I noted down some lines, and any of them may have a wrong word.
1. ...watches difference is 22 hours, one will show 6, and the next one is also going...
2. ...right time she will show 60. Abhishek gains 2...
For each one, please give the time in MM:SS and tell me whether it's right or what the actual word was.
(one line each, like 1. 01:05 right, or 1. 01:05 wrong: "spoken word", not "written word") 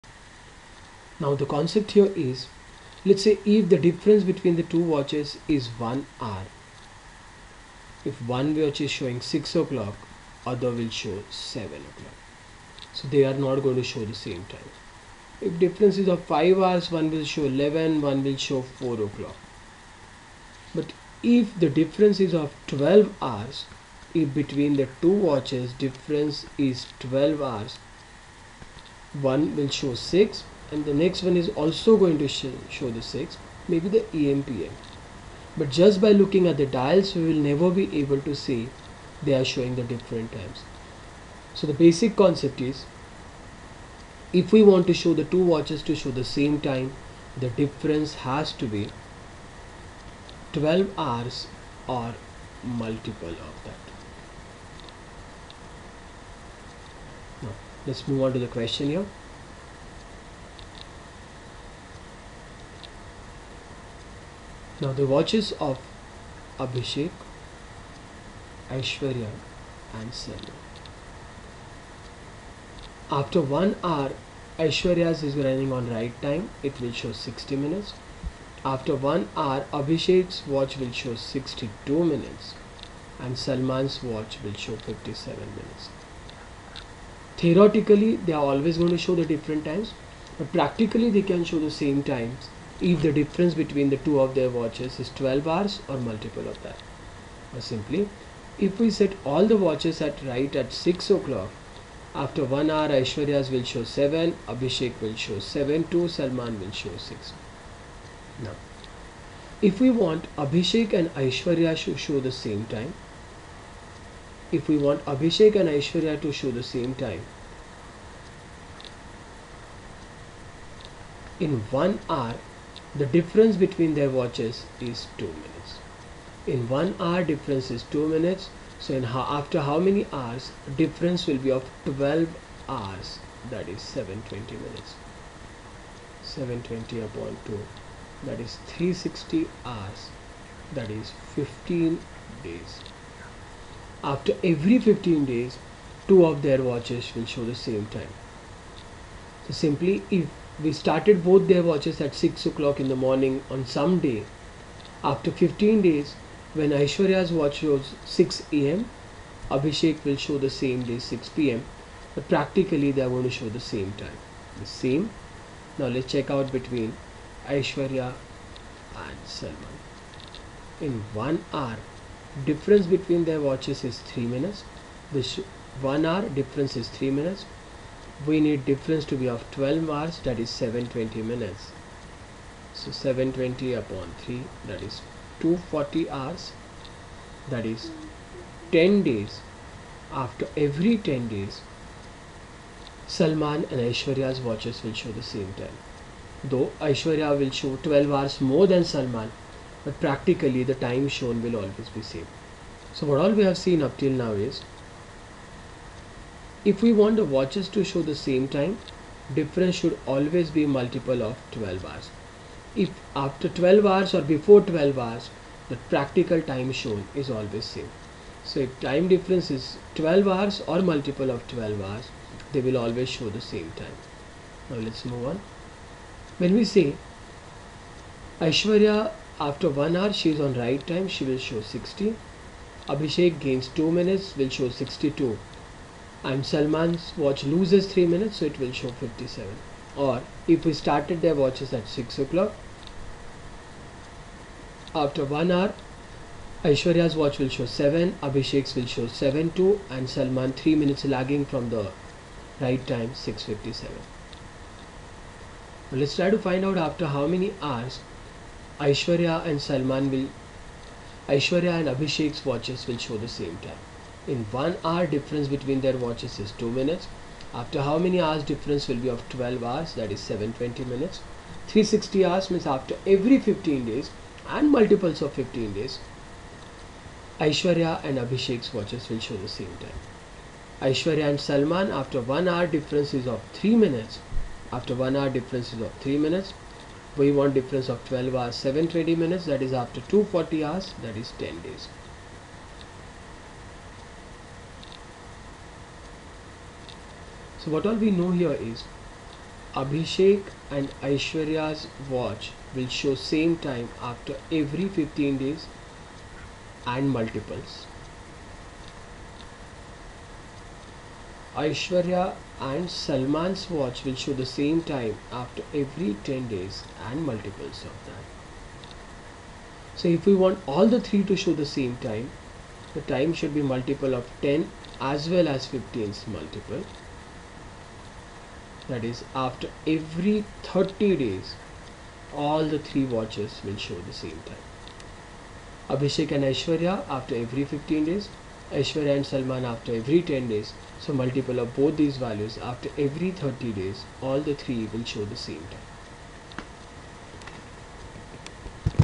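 1. 00:25 wrong: "12", not "22"
2. 03:50 right.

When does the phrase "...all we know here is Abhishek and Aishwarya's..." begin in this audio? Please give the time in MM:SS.
04:57.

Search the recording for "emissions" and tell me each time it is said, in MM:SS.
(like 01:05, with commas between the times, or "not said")
not said.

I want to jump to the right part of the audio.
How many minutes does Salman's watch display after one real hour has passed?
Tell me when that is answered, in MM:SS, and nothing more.
01:24.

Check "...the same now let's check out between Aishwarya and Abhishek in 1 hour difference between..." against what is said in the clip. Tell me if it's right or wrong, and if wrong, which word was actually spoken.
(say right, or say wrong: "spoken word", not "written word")
wrong: "Salman", not "Abhishek".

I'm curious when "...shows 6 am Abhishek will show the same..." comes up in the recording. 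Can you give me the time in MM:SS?
02:37.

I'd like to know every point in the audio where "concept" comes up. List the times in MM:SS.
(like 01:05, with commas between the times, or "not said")
00:01, 00:42.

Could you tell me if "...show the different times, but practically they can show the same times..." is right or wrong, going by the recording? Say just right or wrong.
right.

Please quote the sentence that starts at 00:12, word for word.
So they are not going to show the same time.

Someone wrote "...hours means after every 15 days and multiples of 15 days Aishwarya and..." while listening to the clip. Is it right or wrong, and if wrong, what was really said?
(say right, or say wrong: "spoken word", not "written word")
right.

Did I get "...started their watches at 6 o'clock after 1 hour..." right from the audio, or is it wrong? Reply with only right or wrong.
right.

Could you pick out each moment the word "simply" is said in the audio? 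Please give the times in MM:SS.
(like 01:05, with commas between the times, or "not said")
01:37, 02:29.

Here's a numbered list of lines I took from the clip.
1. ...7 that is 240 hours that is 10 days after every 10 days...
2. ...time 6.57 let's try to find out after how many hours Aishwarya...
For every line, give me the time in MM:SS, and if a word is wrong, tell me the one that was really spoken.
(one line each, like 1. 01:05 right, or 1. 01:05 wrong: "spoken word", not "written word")
1. 03:04 wrong: "3", not "7"
2. 04:12 right.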